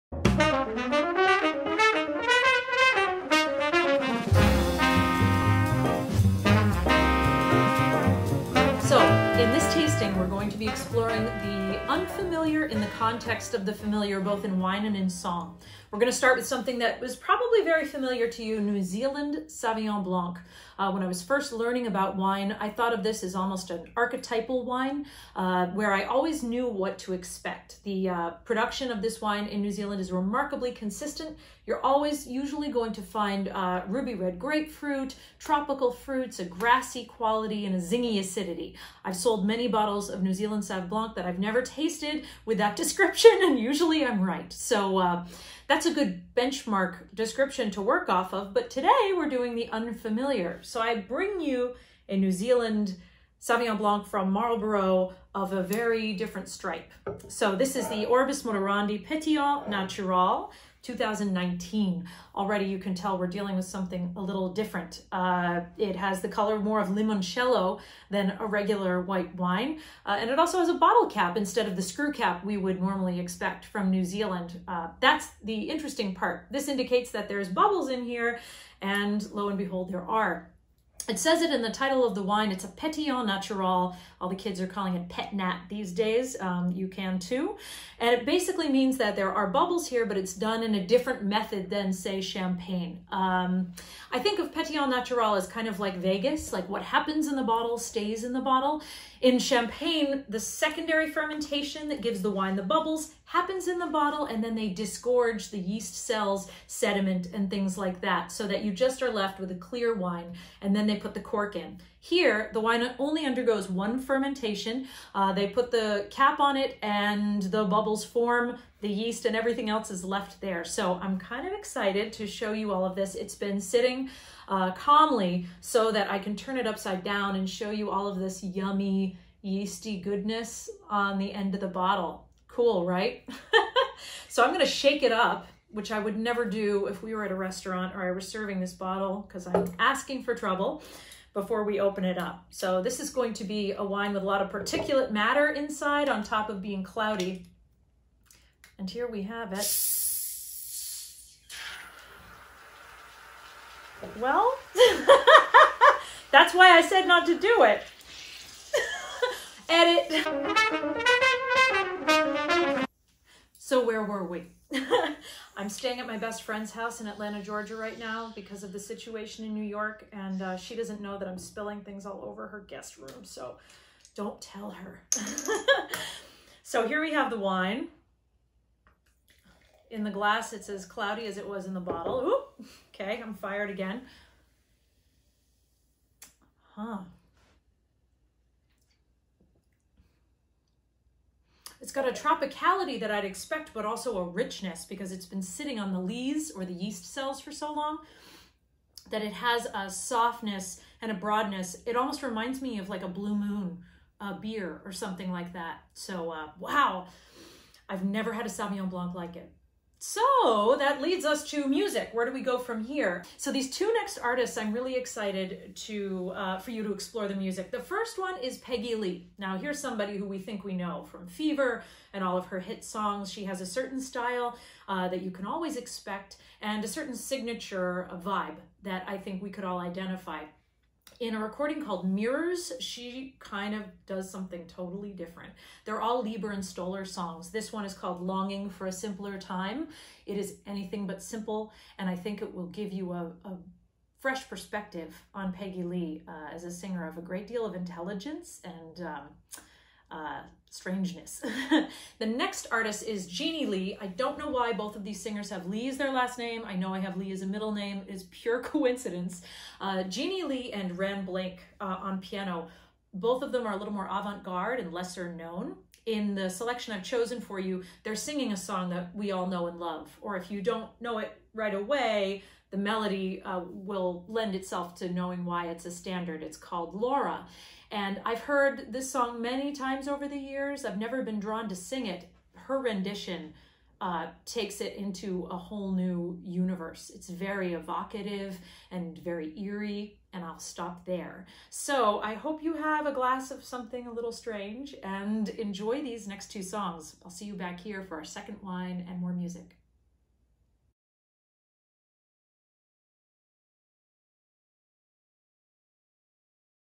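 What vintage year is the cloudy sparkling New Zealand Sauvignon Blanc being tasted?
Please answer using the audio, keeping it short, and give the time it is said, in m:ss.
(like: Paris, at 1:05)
2019, at 1:00.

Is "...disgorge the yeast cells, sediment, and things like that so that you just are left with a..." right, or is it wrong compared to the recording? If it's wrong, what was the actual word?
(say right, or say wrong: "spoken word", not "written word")
right.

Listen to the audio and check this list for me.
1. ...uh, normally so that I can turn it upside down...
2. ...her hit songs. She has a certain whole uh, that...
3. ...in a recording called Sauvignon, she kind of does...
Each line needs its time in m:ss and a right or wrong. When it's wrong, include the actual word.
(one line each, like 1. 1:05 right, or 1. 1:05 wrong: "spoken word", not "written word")
1. 2:04 wrong: "calmly", not "normally"
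2. 3:42 wrong: "style", not "whole"
3. 3:51 wrong: "Mirrors", not "Sauvignon".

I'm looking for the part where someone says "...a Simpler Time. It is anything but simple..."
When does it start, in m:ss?
3:58.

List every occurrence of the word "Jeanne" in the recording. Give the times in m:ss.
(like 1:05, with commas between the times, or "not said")
4:13, 4:20.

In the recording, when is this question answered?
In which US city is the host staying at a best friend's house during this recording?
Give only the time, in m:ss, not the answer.
2:47.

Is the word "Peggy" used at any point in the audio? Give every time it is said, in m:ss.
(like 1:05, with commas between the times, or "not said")
3:38, 4:05.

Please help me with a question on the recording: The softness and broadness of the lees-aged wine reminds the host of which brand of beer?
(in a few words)
Blue Moon.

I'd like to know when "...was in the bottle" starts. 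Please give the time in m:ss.
3:01.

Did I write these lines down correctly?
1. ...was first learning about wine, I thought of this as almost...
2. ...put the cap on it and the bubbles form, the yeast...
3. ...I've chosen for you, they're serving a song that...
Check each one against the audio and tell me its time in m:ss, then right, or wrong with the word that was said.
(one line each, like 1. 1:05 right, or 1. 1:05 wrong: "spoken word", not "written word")
1. 0:21 right
2. 1:55 right
3. 4:26 wrong: "singing", not "serving".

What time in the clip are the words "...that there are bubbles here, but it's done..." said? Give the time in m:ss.
1:28.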